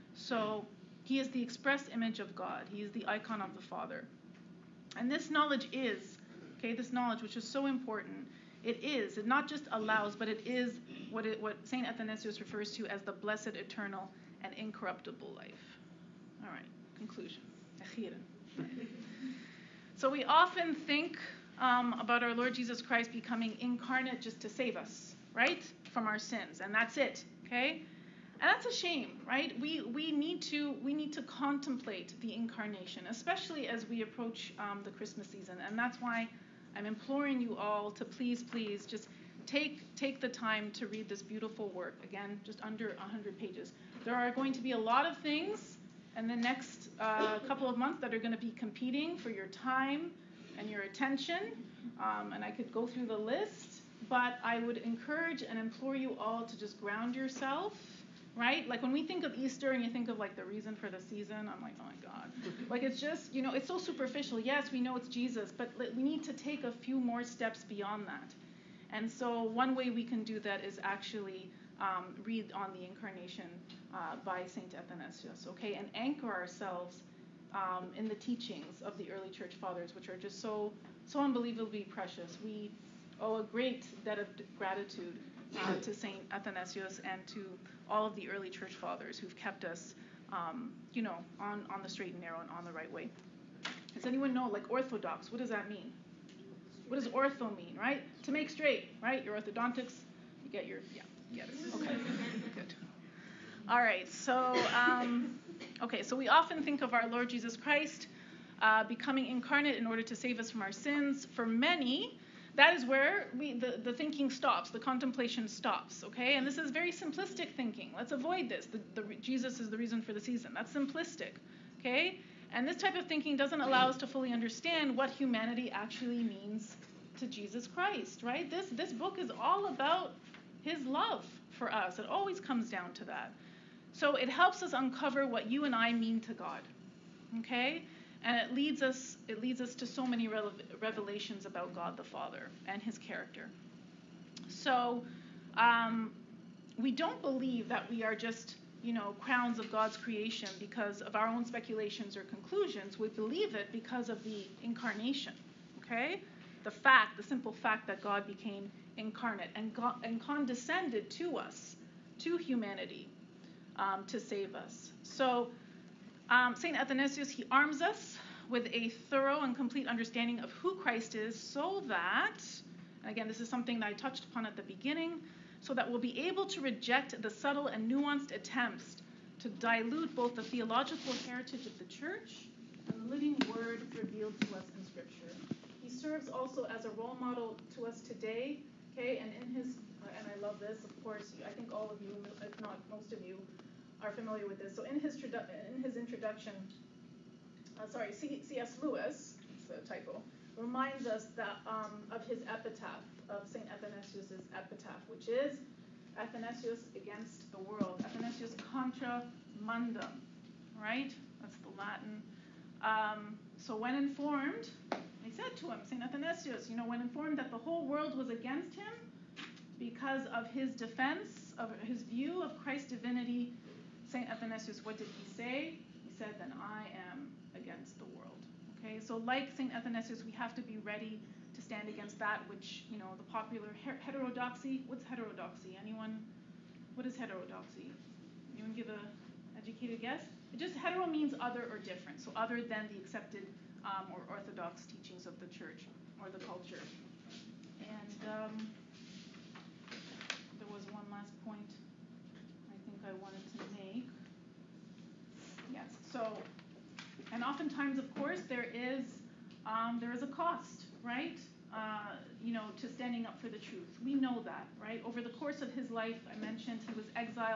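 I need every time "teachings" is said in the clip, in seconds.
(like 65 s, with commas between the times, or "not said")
78 s, 244 s.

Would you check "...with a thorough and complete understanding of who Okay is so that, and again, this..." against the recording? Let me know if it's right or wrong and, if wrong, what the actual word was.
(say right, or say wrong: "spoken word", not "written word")
wrong: "Christ", not "Okay".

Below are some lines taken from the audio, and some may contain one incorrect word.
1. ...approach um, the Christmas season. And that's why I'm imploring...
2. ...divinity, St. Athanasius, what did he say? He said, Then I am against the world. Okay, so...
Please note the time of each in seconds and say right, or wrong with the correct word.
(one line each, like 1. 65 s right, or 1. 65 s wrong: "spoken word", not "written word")
1. 34 s right
2. 222 s right.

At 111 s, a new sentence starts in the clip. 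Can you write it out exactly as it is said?
For many, that is where we, the, the thinking stops, the contemplation stops, okay?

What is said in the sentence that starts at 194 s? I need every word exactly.
So in his, in his introduction, uh, sorry, C.S.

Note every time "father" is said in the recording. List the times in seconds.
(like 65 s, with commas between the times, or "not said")
3 s, 79 s, 88 s, 142 s.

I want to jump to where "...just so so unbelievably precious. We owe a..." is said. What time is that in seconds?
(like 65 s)
80 s.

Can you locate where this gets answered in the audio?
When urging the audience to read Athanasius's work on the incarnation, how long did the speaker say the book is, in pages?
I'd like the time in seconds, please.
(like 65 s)
42 s.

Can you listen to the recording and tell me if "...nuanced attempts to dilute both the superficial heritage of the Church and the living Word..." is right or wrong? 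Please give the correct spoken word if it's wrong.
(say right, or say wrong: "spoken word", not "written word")
wrong: "theological", not "superficial".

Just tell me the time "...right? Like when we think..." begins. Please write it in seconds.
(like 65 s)
58 s.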